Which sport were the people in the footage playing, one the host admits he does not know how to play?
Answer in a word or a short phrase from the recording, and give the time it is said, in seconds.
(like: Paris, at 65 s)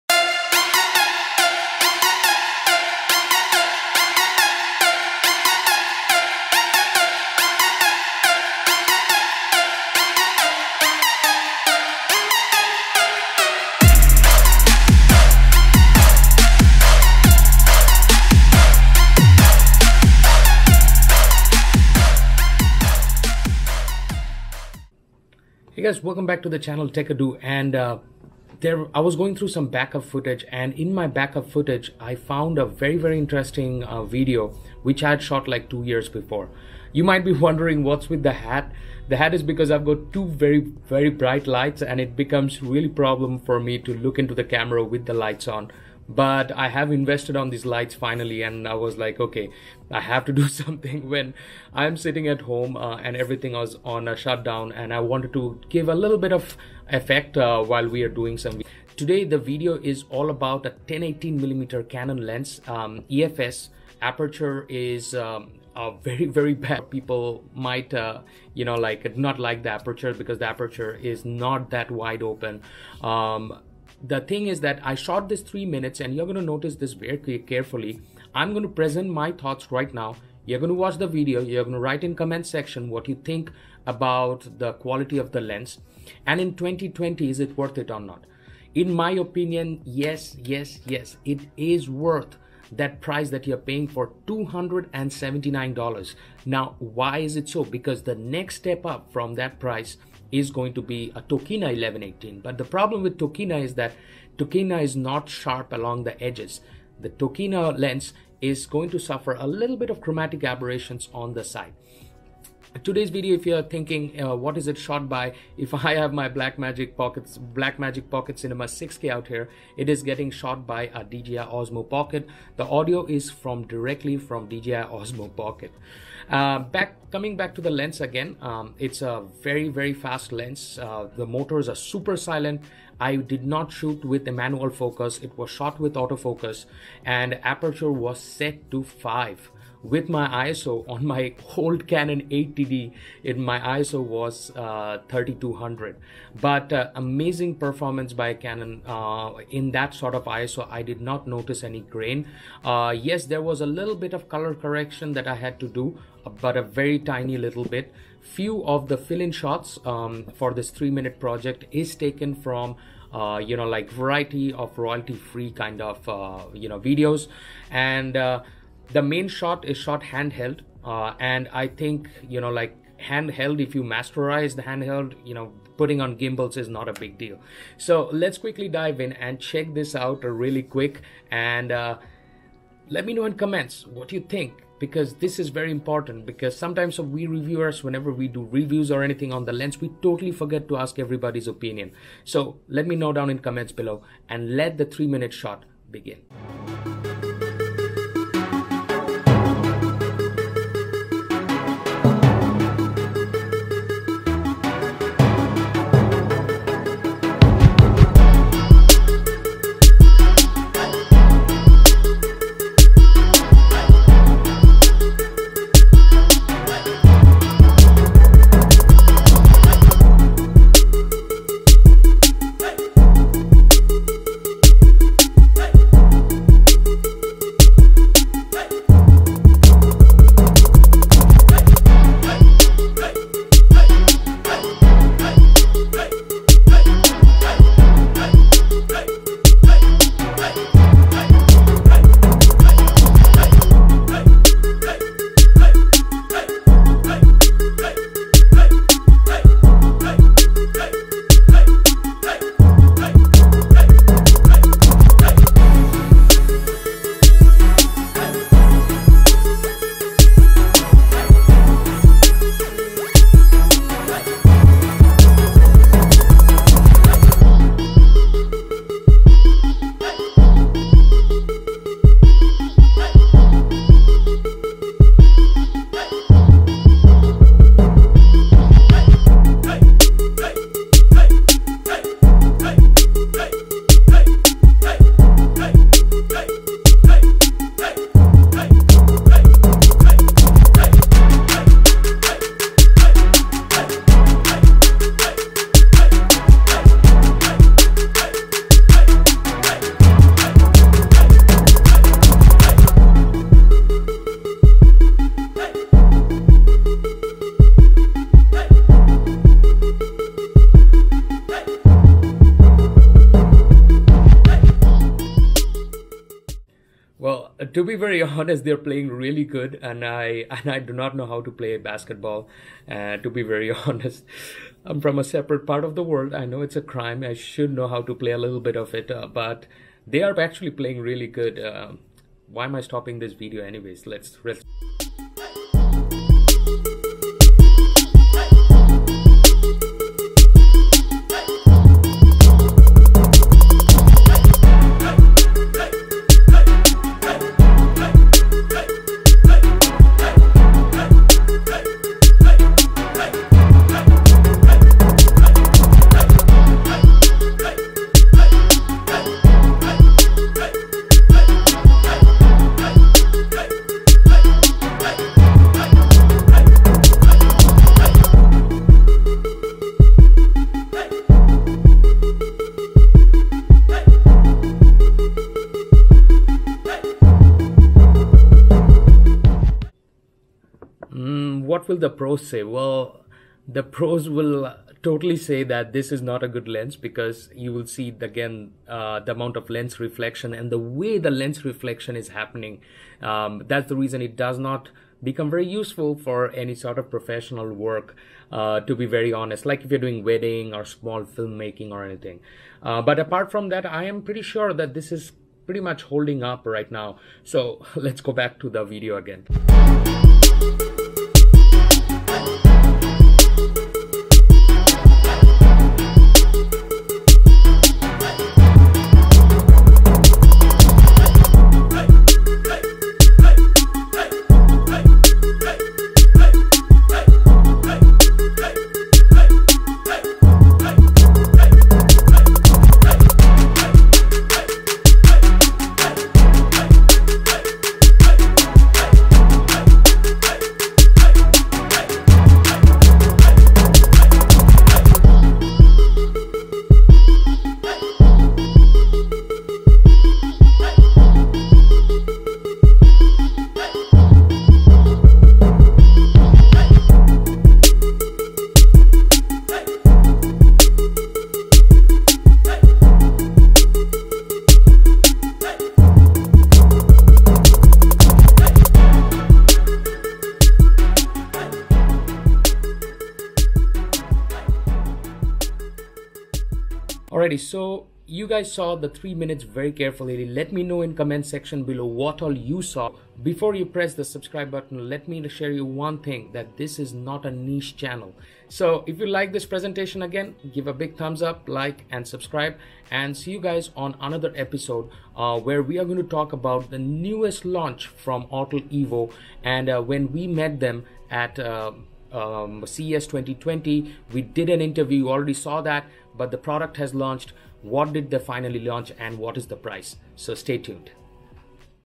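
Basketball, at 321 s.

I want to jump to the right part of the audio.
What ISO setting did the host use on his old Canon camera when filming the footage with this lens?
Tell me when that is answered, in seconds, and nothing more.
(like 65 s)
145 s.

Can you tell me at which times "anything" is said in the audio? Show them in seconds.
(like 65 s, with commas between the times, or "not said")
189 s, 402 s.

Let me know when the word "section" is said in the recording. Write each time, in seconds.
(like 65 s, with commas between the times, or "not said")
82 s, 481 s.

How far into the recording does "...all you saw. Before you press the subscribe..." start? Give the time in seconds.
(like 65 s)
482 s.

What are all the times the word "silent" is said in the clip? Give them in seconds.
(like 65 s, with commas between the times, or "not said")
132 s.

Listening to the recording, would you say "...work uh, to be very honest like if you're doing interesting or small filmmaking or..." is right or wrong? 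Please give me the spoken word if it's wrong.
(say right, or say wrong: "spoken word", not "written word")
wrong: "wedding", not "interesting".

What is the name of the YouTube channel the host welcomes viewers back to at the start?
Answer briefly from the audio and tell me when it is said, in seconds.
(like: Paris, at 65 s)
Techado, at 26 s.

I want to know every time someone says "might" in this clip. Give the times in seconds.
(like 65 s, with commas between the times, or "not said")
37 s, 67 s.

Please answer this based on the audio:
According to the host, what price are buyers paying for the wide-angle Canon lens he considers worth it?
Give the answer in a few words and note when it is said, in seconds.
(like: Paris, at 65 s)
$279, at 94 s.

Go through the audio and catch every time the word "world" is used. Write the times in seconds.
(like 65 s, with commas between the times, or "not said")
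326 s.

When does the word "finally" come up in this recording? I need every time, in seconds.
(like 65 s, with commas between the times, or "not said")
47 s, 508 s.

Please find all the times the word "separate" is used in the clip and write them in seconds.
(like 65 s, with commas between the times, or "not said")
325 s.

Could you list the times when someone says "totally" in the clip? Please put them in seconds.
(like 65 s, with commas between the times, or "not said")
190 s, 385 s.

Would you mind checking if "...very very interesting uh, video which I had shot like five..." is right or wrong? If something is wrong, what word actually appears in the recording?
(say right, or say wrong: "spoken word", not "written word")
wrong: "two", not "five".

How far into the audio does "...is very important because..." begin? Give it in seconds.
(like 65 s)
185 s.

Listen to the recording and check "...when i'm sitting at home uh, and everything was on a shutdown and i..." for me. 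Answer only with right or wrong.
right.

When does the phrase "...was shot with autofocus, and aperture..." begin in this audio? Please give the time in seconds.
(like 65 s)
135 s.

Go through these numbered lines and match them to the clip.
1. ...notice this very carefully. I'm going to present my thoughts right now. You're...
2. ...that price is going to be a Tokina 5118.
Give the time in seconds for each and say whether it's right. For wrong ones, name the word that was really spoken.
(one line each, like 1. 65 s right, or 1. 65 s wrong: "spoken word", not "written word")
1. 76 s right
2. 99 s wrong: "1118", not "5118".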